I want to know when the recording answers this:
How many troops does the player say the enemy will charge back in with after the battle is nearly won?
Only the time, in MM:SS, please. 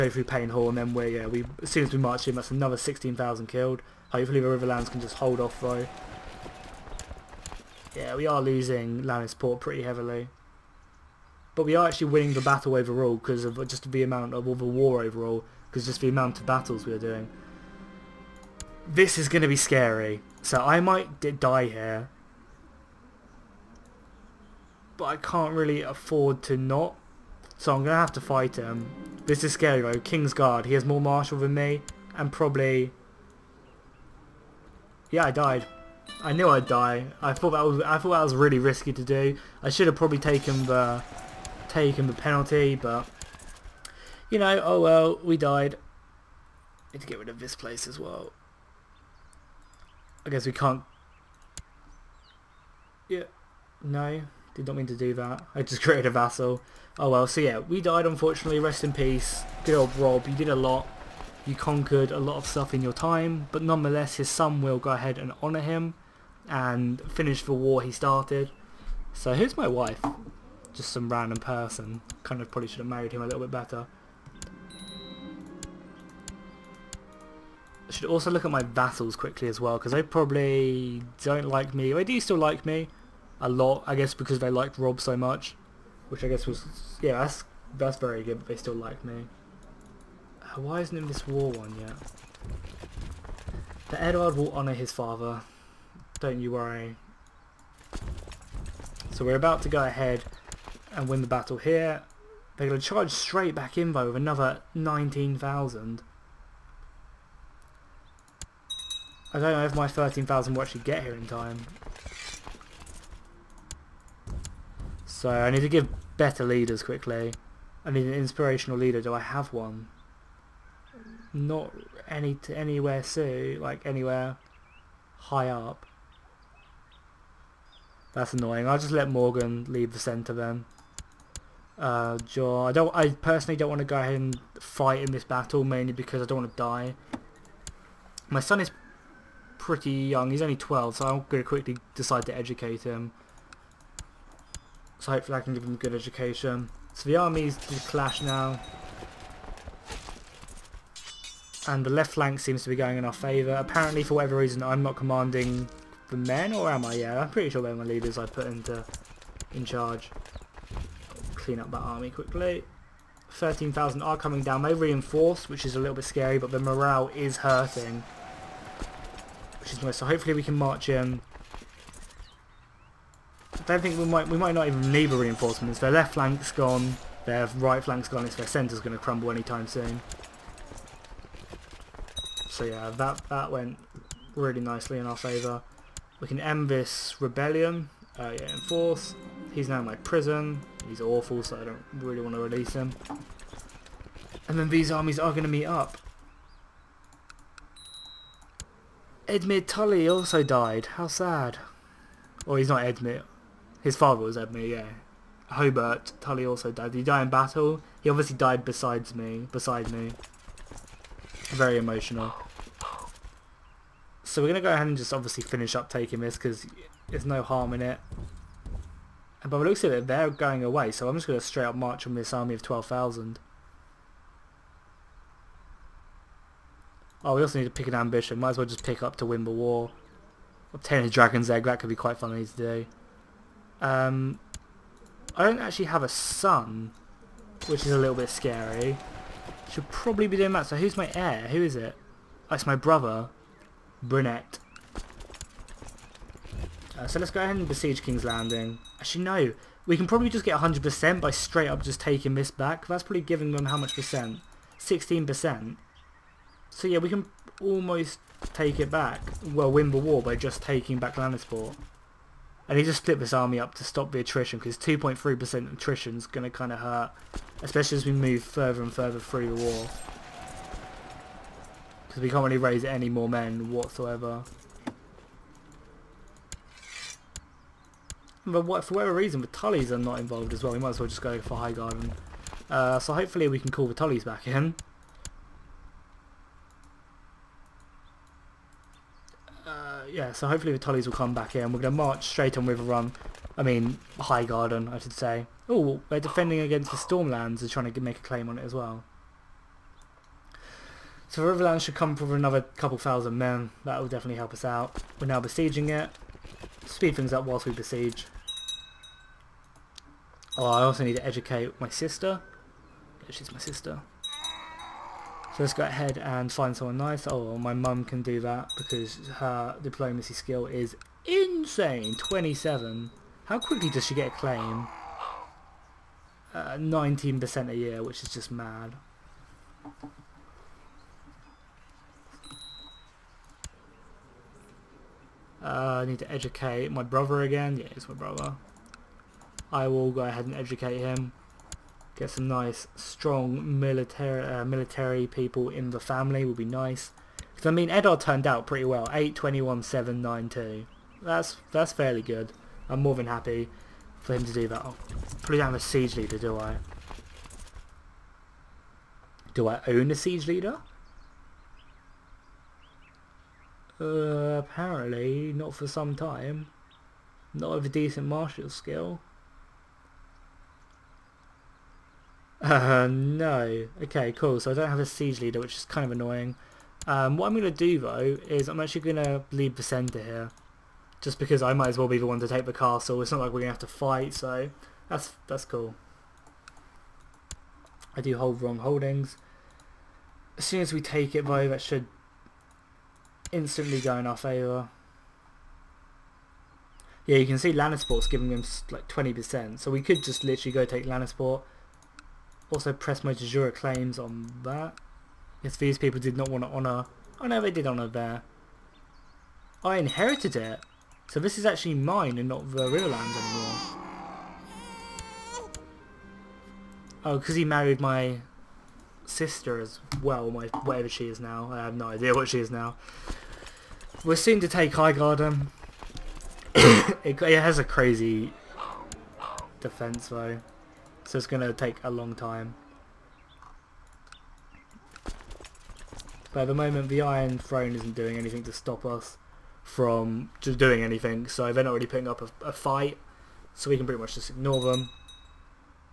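01:44.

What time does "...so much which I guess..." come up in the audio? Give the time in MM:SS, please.
01:25.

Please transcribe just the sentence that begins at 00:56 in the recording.
Oh well, so yeah, we died unfortunately, rest in peace.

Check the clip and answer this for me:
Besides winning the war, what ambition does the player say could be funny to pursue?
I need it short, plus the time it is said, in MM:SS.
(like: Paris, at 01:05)
Obtain a dragon's egg, at 03:50.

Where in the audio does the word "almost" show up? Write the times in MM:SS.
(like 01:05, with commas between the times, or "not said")
04:17.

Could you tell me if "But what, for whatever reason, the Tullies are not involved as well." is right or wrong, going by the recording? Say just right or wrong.
right.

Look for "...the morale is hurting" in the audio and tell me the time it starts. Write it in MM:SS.
02:46.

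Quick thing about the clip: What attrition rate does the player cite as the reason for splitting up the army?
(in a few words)
2.3%.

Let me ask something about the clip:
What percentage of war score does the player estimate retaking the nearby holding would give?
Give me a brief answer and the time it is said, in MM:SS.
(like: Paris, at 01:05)
16%, at 04:14.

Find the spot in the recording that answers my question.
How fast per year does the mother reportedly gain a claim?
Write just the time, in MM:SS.
05:26.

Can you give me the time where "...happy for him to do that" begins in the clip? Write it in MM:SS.
05:53.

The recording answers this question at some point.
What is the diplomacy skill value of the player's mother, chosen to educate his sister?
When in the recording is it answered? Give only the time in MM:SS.
05:22.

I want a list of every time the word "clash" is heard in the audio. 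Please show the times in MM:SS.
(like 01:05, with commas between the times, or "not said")
02:27.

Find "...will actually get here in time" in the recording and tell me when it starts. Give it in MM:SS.
01:50.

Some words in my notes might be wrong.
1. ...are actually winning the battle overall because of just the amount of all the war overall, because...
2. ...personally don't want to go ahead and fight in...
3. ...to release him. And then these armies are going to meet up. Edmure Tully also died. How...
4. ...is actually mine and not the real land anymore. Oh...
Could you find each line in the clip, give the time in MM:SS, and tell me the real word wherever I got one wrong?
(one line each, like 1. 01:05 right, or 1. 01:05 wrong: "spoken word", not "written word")
1. 00:11 right
2. 02:13 right
3. 03:12 right
4. 06:51 right.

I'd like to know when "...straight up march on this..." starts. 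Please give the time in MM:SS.
03:41.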